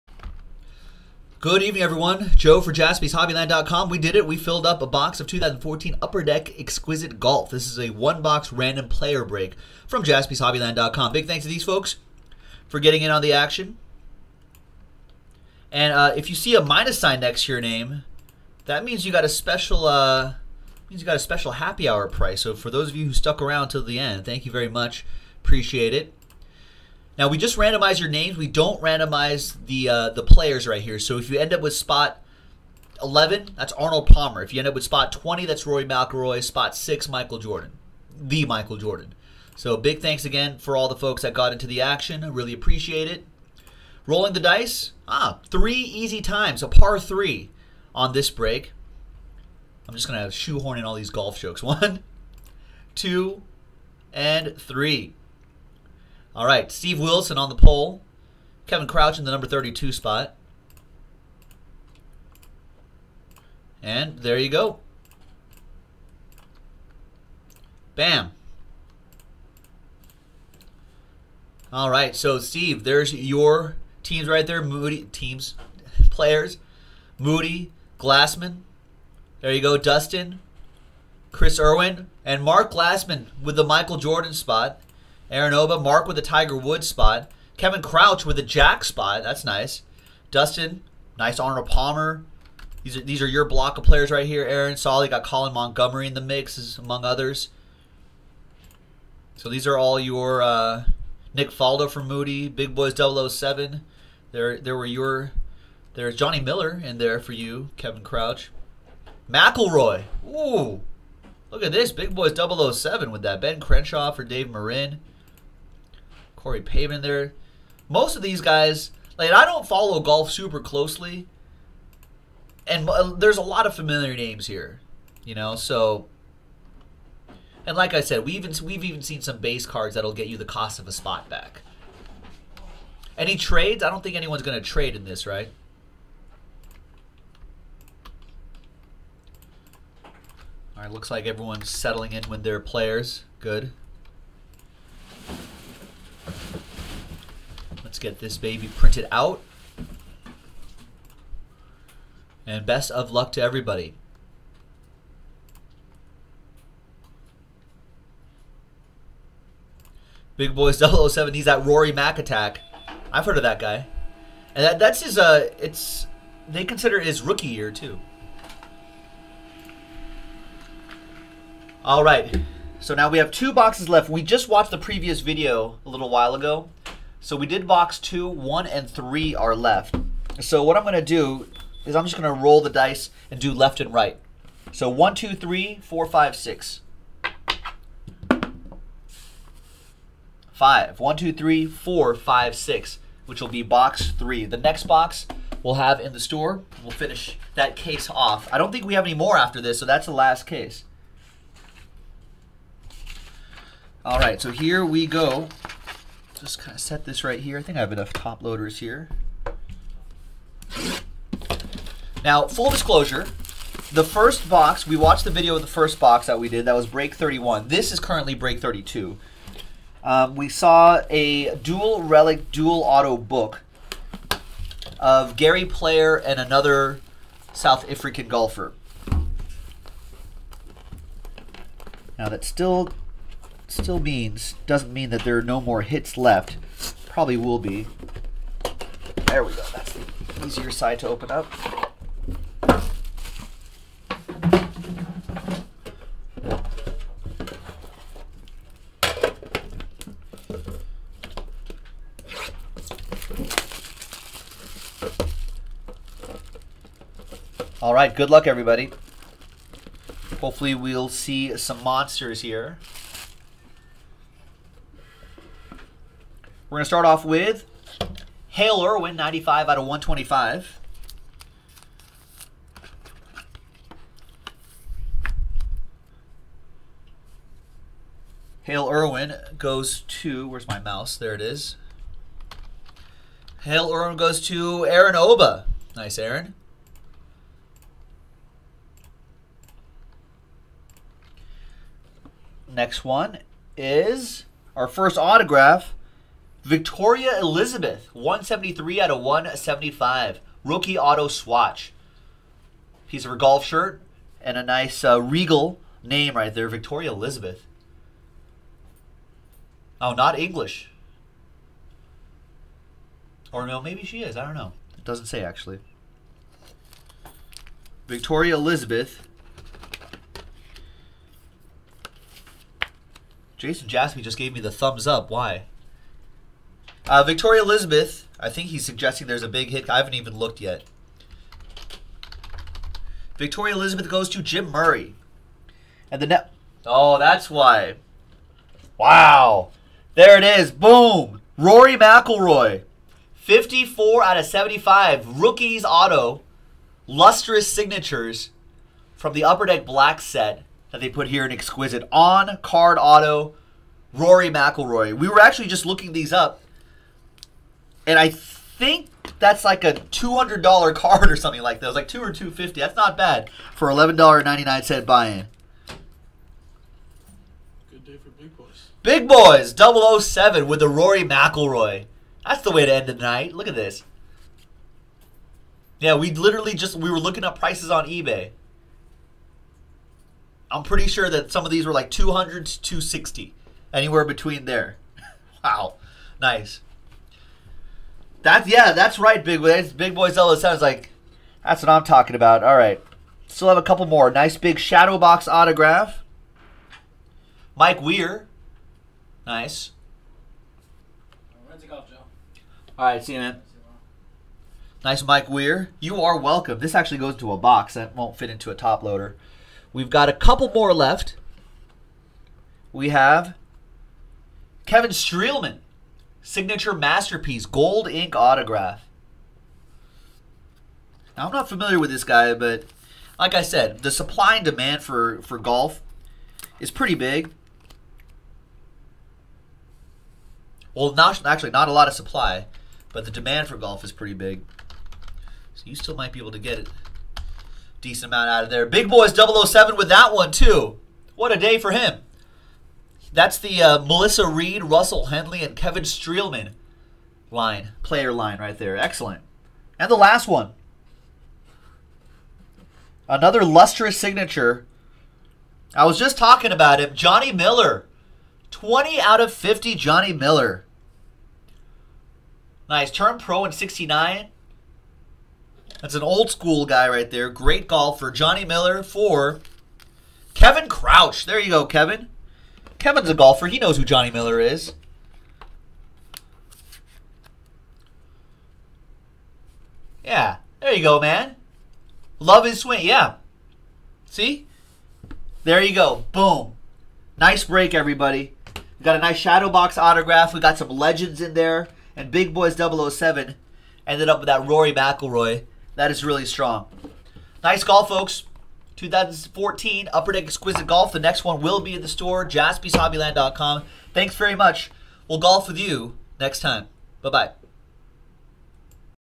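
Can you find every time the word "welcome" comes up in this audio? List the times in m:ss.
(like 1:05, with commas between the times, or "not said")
6:46.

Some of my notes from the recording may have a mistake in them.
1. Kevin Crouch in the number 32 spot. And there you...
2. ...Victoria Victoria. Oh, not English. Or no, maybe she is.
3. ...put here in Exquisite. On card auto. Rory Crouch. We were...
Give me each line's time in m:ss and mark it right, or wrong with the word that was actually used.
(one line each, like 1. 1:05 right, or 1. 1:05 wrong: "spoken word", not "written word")
1. 0:58 right
2. 5:06 wrong: "Elizabeth", not "Victoria"
3. 5:51 wrong: "McIlroy", not "Crouch".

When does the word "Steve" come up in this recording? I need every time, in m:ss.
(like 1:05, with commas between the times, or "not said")
0:56, 1:12.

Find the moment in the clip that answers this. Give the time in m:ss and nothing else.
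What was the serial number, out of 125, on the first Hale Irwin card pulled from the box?
4:29.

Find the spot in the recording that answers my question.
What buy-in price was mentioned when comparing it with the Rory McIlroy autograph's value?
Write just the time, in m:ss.
6:03.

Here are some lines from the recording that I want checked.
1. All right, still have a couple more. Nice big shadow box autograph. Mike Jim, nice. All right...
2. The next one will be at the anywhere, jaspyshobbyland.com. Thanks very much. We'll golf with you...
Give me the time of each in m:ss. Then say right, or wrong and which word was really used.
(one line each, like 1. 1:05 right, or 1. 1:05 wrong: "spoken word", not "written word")
1. 6:32 wrong: "Weir", not "Jim"
2. 8:21 wrong: "store", not "anywhere".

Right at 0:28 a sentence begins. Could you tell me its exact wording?
We don't randomize the uh, the players right here.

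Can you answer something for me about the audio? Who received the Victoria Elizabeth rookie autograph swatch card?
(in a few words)
Jim Murray.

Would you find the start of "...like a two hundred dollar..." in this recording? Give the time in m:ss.
5:59.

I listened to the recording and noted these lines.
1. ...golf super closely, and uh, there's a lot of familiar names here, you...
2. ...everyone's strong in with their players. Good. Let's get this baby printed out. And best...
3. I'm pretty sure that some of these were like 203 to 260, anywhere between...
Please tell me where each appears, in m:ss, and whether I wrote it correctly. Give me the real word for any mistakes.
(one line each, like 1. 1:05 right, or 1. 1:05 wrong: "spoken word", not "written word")
1. 1:59 right
2. 2:21 wrong: "settling", not "strong"
3. 6:20 wrong: "200", not "203".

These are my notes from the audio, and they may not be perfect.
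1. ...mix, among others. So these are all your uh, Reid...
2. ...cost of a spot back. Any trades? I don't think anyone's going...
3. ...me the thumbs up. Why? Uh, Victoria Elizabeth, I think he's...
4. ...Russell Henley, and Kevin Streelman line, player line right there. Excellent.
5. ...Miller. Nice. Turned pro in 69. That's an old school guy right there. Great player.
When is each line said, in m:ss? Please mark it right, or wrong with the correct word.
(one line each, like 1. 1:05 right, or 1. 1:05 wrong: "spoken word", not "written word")
1. 1:36 wrong: "Nick", not "Reid"
2. 2:10 right
3. 5:24 right
4. 7:24 right
5. 7:40 wrong: "golfer", not "player".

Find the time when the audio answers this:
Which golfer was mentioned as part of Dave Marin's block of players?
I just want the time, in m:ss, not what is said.
1:53.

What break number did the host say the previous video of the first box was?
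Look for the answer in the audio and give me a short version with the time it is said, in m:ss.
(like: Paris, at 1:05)
31, at 3:36.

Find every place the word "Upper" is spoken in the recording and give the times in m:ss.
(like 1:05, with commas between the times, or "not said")
0:05, 5:49, 8:20.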